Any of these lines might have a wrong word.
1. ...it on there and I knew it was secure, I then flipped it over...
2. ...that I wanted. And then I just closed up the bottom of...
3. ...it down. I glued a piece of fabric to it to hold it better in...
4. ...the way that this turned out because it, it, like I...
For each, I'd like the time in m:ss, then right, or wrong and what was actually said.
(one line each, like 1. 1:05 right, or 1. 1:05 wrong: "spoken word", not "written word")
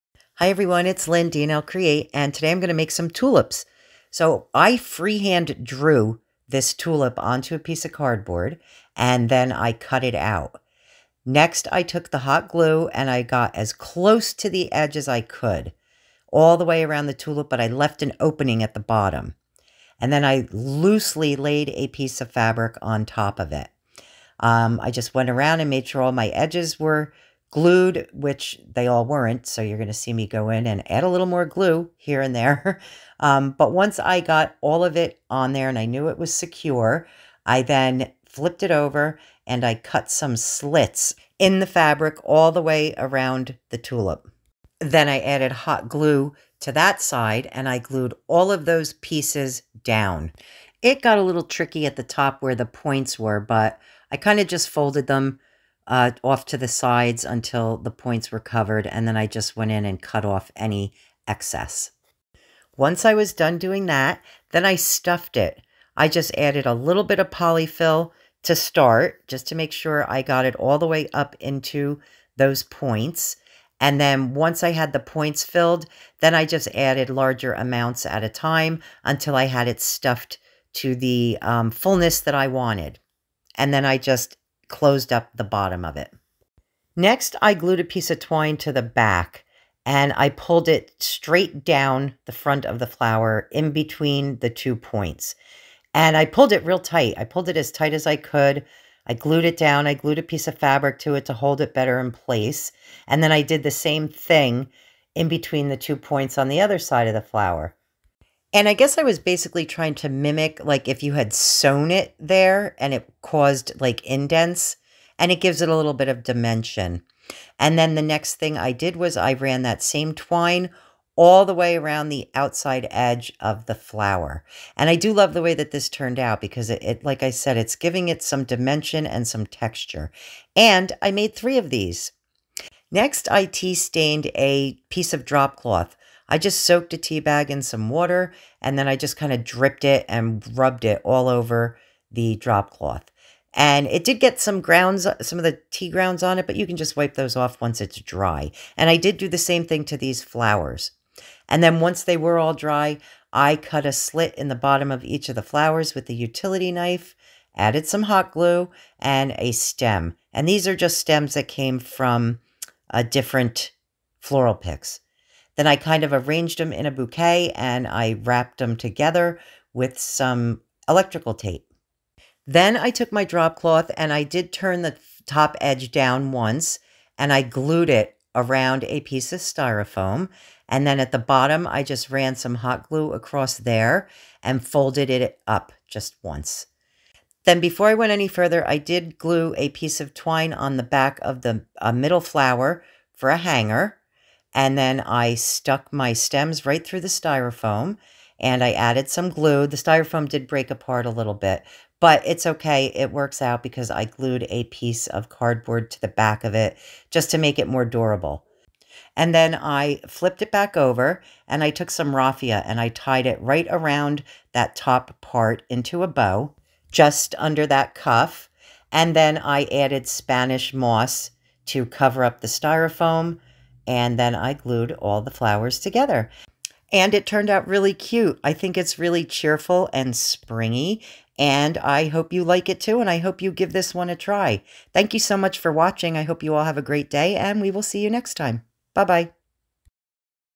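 1. 0:34 right
2. 1:22 right
3. 1:39 right
4. 2:05 right.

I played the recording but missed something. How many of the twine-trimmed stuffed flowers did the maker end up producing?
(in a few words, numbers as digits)
3.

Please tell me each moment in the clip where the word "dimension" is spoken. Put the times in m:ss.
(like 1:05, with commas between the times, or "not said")
1:56, 2:08.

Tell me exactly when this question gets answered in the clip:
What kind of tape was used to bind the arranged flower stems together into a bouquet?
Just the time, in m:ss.
2:50.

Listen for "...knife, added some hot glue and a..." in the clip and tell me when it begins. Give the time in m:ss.
2:36.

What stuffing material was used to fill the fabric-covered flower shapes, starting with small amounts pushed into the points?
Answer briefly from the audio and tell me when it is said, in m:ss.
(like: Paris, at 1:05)
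polyfill, at 1:07.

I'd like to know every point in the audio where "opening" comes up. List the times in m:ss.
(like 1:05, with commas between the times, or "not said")
0:18.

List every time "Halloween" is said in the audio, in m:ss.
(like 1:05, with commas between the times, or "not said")
not said.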